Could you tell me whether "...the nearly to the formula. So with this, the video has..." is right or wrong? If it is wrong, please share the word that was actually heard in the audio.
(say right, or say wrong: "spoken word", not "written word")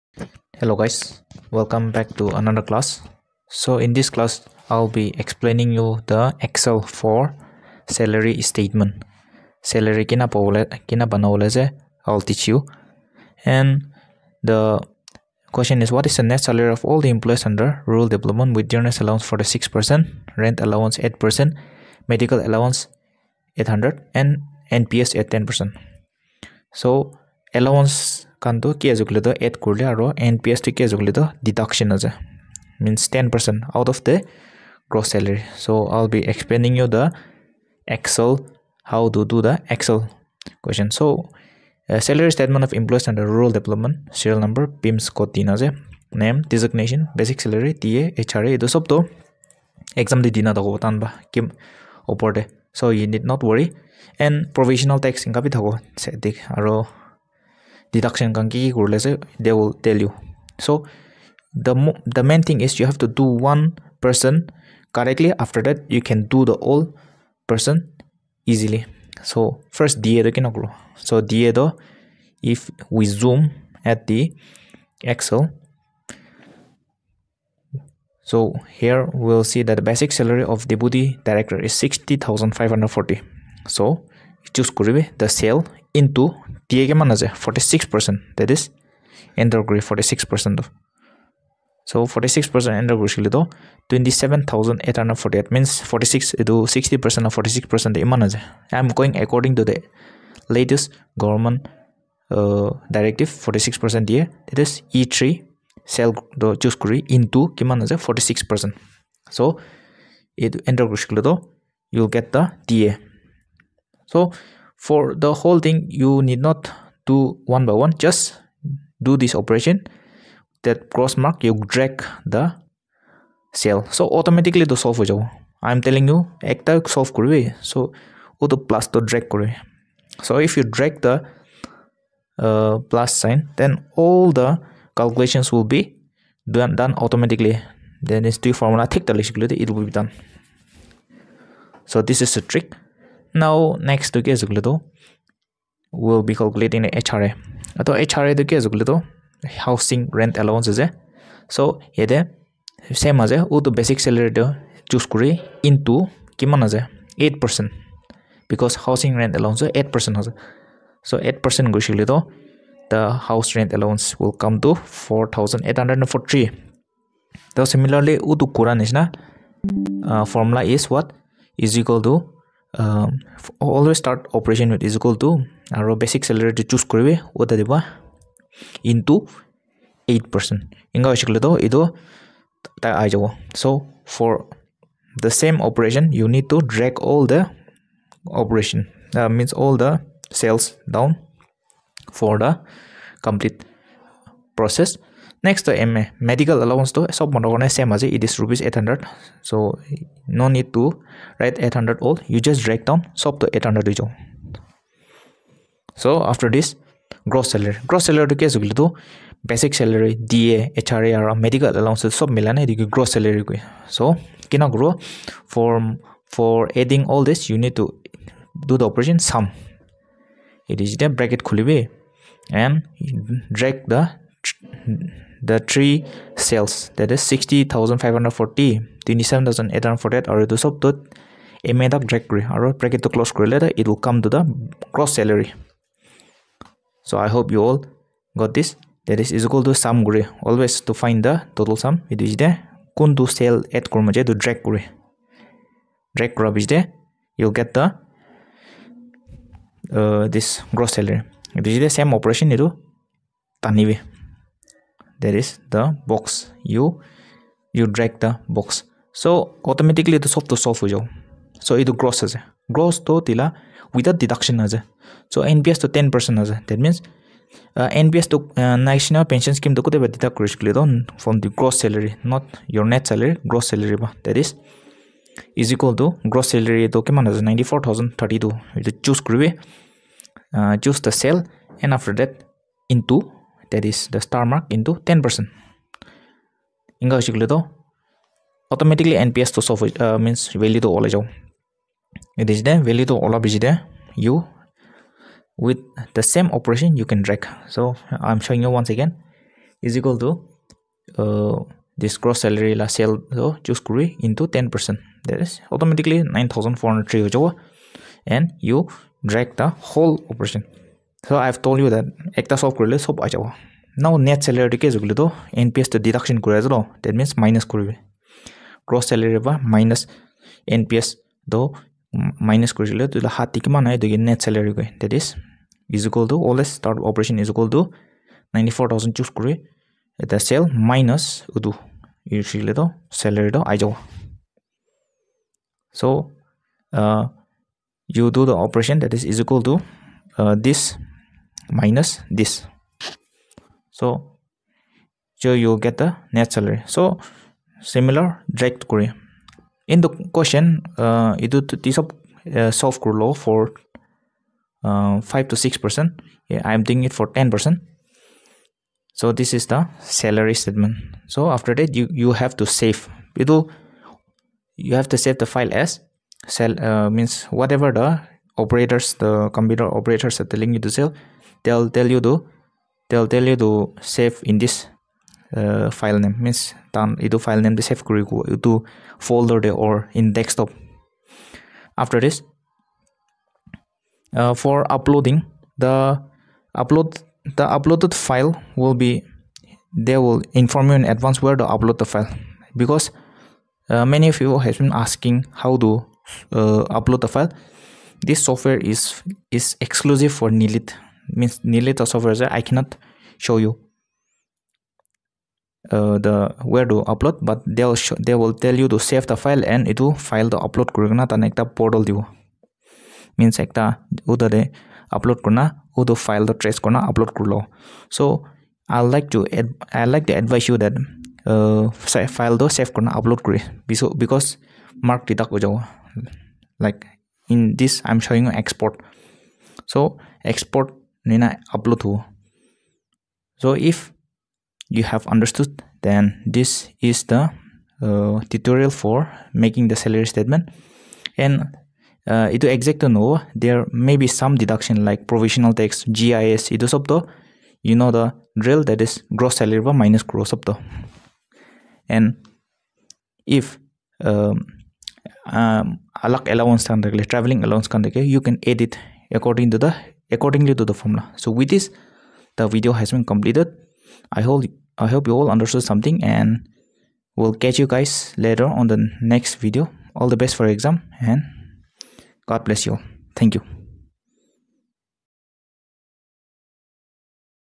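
wrong: "accordingly", not "nearly".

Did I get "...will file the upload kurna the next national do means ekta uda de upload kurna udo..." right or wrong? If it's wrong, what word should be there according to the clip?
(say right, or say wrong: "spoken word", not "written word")
wrong: "portal", not "national".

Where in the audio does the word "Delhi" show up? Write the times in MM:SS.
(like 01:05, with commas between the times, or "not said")
not said.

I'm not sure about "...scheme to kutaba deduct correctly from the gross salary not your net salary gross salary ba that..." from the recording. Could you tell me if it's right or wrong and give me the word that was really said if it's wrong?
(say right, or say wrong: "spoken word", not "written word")
right.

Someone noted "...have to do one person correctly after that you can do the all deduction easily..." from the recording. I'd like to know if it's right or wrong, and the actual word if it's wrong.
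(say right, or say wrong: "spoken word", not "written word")
wrong: "person", not "deduction".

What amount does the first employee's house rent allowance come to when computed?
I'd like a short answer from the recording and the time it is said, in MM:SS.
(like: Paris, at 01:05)
4843, at 02:45.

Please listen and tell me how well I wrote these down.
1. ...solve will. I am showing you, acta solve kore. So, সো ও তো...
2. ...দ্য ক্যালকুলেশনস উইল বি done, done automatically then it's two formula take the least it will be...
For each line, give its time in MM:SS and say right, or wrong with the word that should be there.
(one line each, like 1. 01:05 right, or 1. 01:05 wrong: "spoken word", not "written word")
1. 02:04 wrong: "telling", not "showing"
2. 02:14 right.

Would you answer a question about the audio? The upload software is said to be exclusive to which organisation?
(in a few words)
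NIELIT.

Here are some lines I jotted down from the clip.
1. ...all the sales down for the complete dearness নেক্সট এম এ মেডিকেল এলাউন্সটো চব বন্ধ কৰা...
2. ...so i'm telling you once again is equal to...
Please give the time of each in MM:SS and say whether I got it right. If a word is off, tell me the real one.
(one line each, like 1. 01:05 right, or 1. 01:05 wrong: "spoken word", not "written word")
1. 03:09 wrong: "process", not "dearness"
2. 04:57 wrong: "showing", not "telling".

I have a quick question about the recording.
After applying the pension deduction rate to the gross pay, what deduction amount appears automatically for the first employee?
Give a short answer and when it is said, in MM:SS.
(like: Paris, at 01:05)
9403, at 05:06.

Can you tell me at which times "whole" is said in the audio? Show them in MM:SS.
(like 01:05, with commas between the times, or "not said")
01:55, 05:09.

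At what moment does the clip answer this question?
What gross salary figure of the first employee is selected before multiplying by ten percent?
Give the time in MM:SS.
04:37.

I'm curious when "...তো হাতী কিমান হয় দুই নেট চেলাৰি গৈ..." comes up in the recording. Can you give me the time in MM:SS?
05:23.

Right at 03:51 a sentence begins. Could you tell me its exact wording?
A made up drag, or bracket to close, it will come to the cross salary.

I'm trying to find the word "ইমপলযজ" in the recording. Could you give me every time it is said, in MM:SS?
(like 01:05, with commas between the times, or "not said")
00:42.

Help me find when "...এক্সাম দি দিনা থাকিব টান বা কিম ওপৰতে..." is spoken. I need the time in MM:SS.
00:50.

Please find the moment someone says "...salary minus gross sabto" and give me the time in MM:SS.
07:29.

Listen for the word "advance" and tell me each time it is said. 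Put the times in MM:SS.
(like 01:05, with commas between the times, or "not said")
06:31.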